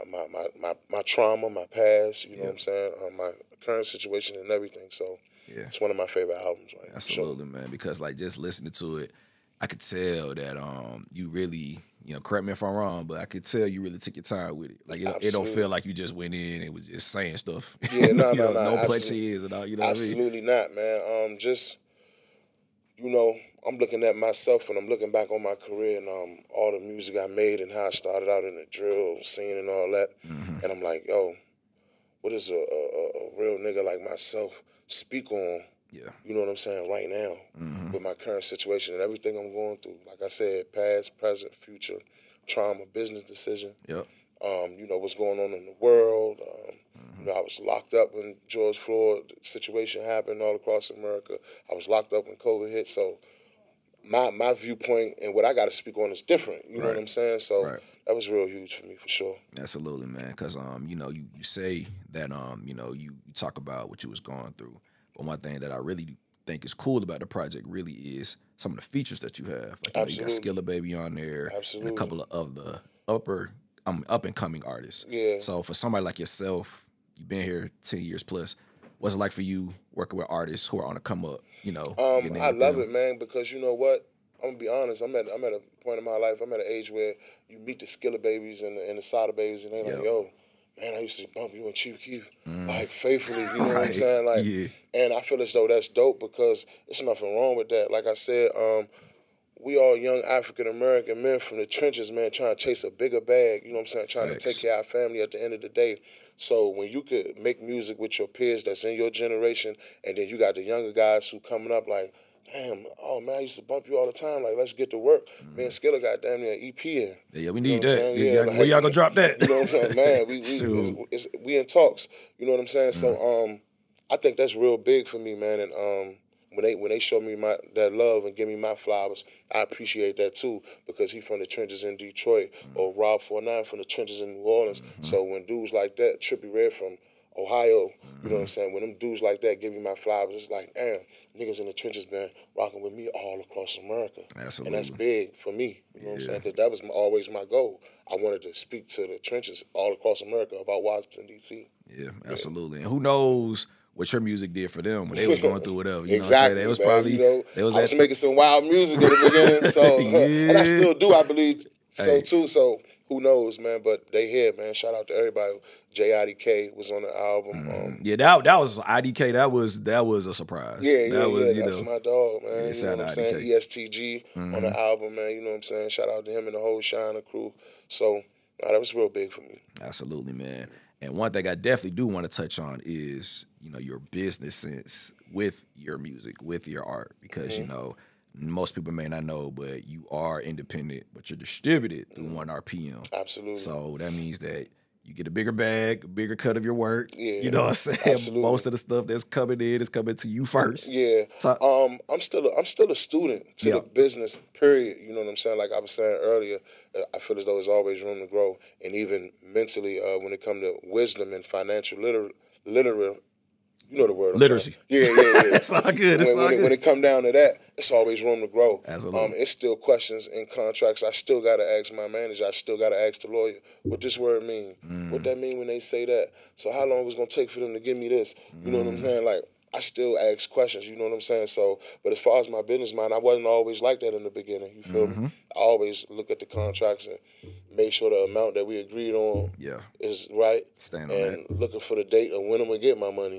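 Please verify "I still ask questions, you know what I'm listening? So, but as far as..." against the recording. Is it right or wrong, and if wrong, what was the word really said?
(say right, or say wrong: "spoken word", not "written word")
wrong: "saying", not "listening".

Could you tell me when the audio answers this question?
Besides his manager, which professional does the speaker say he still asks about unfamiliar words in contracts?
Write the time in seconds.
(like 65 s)
223 s.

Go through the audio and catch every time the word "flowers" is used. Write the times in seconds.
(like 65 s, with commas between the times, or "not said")
128 s, 139 s.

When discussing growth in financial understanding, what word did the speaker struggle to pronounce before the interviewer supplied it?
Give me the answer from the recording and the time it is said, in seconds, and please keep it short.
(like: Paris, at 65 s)
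Literacy, at 214 s.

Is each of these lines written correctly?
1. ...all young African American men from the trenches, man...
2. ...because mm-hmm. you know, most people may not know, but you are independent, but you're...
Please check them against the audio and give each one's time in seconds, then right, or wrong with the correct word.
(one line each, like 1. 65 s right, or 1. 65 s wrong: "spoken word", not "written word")
1. 99 s right
2. 187 s right.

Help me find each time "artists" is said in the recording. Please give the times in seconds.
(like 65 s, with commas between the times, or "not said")
74 s, 80 s.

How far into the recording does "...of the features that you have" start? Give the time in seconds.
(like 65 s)
68 s.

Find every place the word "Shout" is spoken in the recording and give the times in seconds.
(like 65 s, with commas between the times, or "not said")
164 s, 175 s.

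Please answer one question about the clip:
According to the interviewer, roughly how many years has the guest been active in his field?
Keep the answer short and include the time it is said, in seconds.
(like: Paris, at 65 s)
10 years plus, at 77 s.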